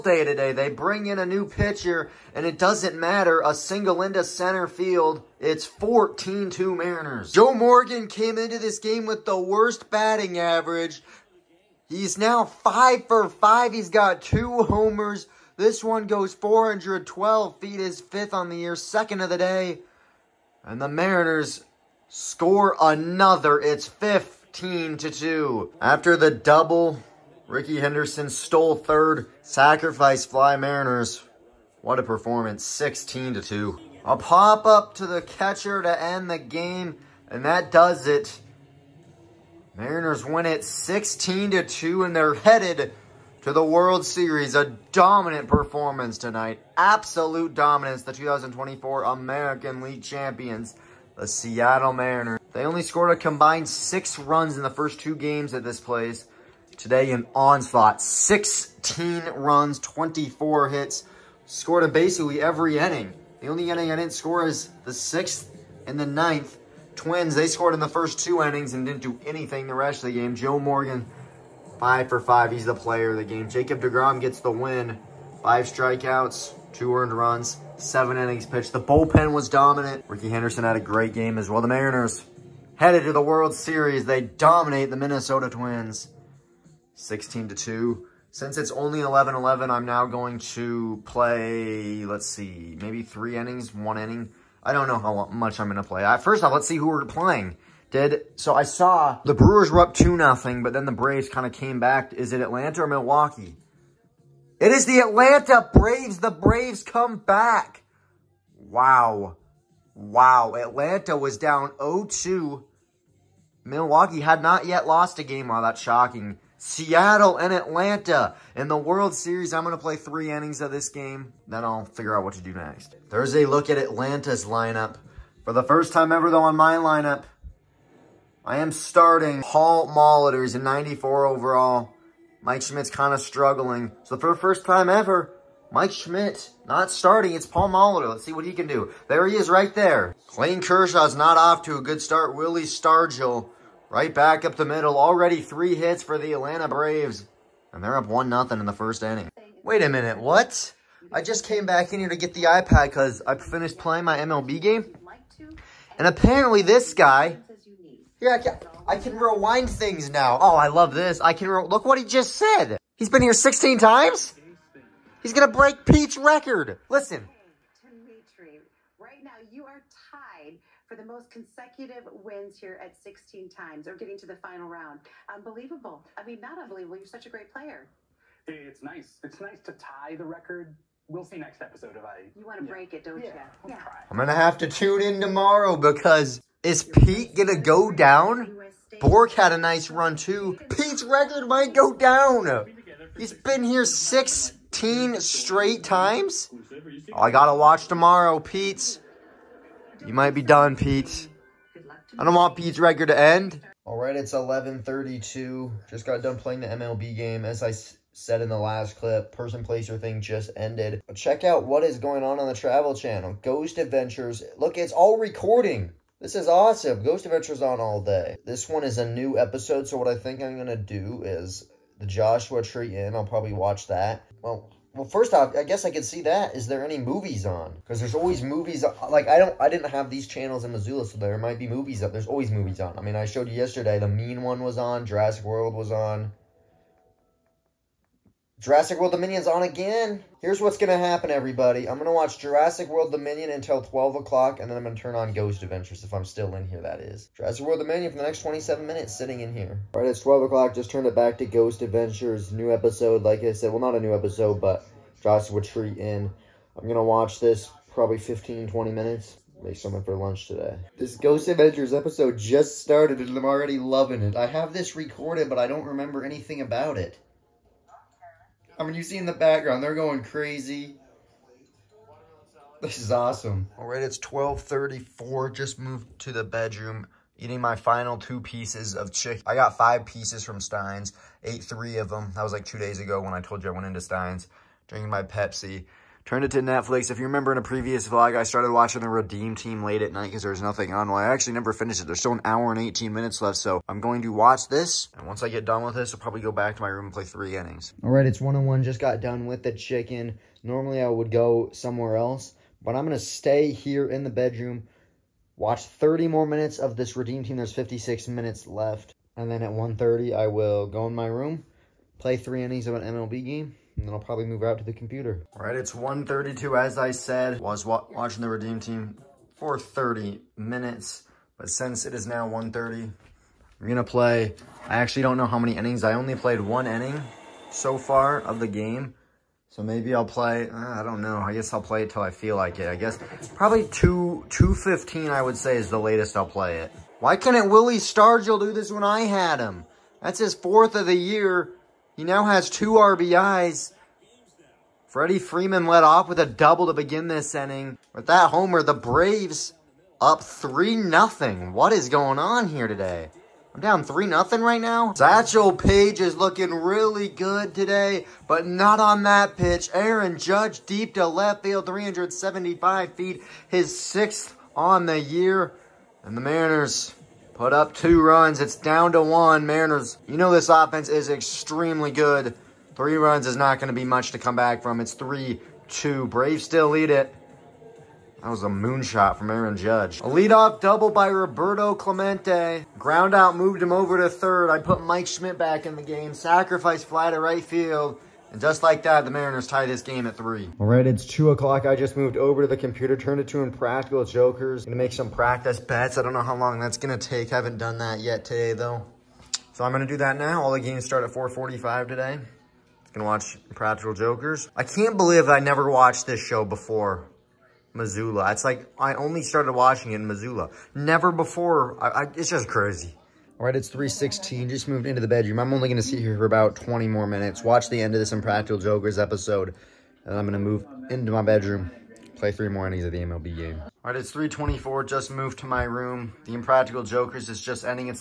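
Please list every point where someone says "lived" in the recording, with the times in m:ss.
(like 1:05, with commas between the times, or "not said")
not said.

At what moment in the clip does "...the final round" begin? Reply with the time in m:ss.
2:54.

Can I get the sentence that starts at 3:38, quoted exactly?
This one is a new episode, so what I think I'm going to do is the Joshua Tree Inn.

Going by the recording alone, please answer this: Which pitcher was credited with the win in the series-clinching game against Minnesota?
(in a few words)
Jacob DeGrom.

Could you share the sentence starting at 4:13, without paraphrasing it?
Well, not a new episode, but Joshua Tree Inn.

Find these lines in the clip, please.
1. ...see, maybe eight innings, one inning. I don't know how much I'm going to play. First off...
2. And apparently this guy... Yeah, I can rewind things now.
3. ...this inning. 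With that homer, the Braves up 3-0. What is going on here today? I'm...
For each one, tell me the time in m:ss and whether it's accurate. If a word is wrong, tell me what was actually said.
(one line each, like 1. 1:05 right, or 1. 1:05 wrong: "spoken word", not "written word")
1. 1:32 wrong: "three", not "eight"
2. 2:35 right
3. 5:47 right.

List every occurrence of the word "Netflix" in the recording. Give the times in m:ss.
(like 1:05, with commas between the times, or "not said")
4:46.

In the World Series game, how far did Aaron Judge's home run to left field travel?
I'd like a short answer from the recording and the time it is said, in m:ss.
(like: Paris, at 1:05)
375 feet, at 6:01.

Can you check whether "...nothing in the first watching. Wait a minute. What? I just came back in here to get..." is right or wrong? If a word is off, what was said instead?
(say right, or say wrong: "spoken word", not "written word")
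wrong: "inning", not "watching".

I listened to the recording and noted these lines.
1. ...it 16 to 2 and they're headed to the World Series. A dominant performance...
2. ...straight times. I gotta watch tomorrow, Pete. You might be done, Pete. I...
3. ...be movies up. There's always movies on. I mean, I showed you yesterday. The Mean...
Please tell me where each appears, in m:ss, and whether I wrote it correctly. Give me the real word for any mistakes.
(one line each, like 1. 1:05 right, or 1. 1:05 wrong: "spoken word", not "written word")
1. 0:40 right
2. 3:15 right
3. 3:51 right.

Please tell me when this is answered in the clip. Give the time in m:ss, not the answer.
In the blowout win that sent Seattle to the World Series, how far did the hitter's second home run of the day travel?
0:16.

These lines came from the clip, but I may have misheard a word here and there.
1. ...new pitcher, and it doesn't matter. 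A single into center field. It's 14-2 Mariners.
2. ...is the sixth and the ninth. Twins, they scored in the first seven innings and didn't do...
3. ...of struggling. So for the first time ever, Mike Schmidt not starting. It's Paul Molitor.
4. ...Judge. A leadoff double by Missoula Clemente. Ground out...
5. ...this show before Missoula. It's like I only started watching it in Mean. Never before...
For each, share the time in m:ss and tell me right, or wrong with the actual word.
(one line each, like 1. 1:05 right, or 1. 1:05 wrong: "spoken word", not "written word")
1. 0:01 right
2. 1:04 wrong: "two", not "seven"
3. 2:13 right
4. 6:19 wrong: "Roberto", not "Missoula"
5. 6:46 wrong: "Missoula", not "Mean".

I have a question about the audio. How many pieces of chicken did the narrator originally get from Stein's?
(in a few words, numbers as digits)
5.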